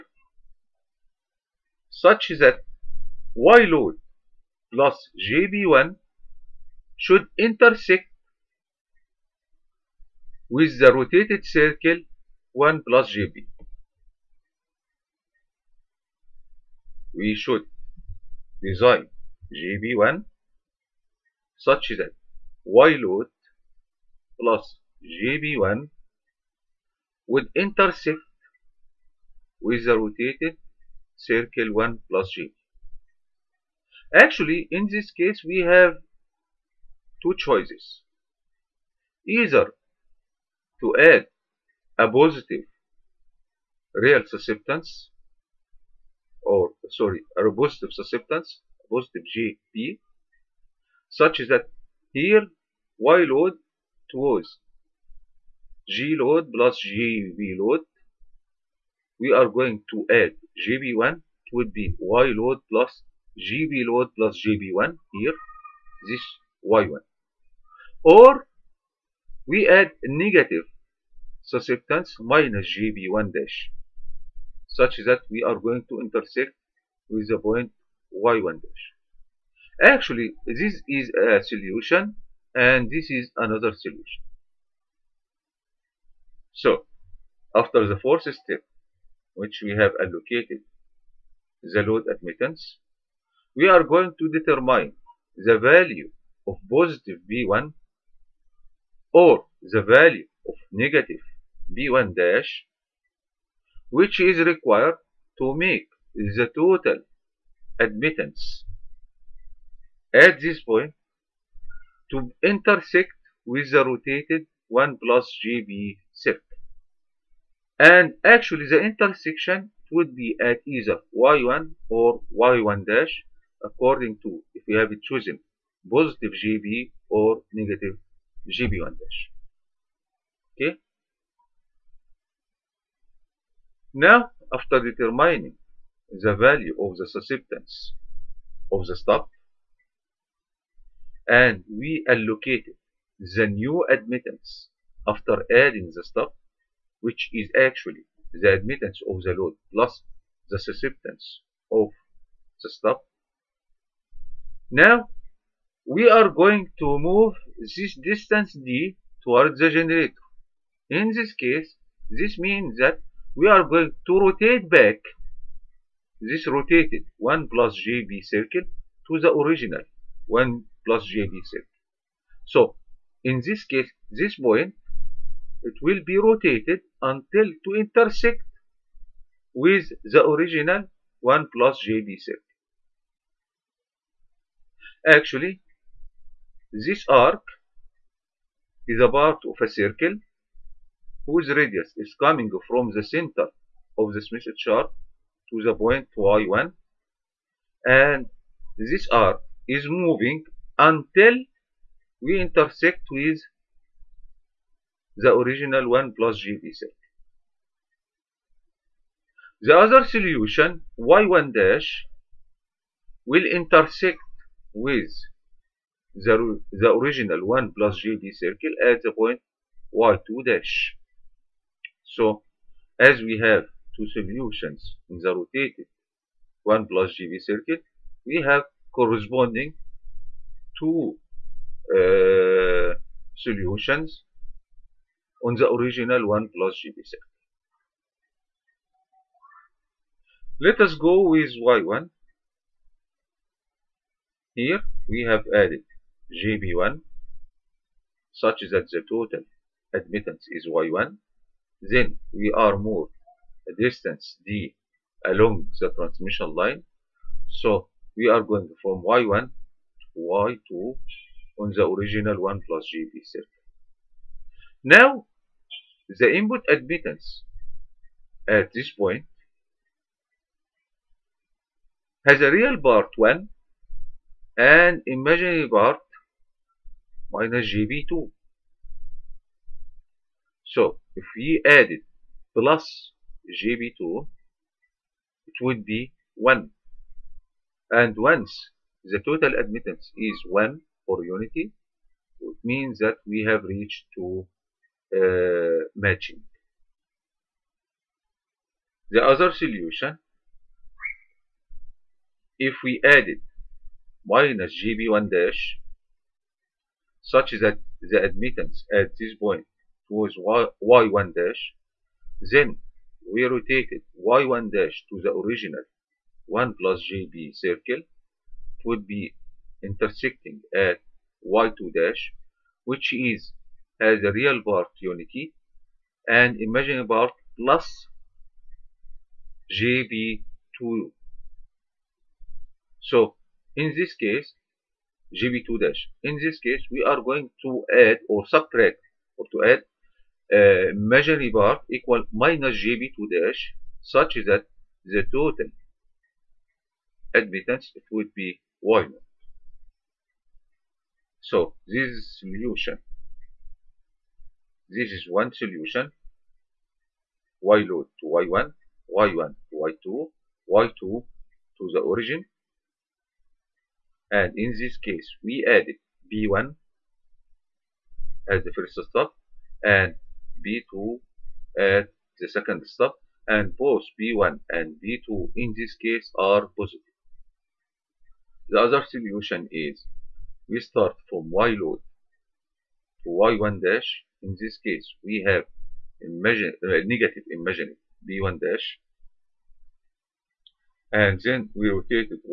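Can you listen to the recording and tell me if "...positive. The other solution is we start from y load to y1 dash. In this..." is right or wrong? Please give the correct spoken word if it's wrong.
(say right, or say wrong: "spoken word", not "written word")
right.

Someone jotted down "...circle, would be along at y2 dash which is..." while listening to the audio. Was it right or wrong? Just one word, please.
wrong.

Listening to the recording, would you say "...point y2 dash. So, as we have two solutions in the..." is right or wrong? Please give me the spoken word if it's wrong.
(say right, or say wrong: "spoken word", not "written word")
right.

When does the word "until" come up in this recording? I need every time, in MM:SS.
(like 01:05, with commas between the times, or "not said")
02:57, 03:20.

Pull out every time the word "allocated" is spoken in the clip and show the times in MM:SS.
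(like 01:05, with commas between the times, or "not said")
01:29, 02:22.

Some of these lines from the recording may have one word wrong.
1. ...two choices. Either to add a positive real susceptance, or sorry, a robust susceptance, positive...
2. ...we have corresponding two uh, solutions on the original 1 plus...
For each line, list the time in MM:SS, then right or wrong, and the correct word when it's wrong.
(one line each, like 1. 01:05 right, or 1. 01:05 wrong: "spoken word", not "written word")
1. 00:37 right
2. 03:48 right.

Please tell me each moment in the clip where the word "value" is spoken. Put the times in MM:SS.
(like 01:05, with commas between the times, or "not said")
01:35, 01:39, 02:16.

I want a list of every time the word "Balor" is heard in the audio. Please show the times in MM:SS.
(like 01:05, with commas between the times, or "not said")
not said.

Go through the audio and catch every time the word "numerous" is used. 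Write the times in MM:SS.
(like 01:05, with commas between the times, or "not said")
not said.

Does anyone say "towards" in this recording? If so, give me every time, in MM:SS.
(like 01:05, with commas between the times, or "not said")
00:54, 02:39.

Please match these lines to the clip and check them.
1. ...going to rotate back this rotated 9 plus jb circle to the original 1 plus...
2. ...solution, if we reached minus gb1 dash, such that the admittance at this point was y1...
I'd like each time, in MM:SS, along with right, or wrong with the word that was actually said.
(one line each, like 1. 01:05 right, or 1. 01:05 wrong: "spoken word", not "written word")
1. 02:43 wrong: "1", not "9"
2. 04:59 wrong: "added", not "reached".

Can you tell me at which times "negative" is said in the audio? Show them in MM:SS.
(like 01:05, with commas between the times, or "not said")
01:10, 01:40, 02:07, 06:27.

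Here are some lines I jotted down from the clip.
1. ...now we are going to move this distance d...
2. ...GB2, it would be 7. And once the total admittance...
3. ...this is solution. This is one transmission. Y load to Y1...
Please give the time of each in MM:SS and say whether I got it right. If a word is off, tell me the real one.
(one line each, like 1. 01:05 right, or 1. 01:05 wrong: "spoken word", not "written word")
1. 02:34 right
2. 04:43 wrong: "1", not "7"
3. 05:51 wrong: "solution", not "transmission".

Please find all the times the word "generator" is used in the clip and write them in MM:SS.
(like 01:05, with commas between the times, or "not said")
02:39.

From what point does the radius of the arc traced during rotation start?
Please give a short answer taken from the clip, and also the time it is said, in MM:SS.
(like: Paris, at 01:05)
Center of the Smith chart, at 03:13.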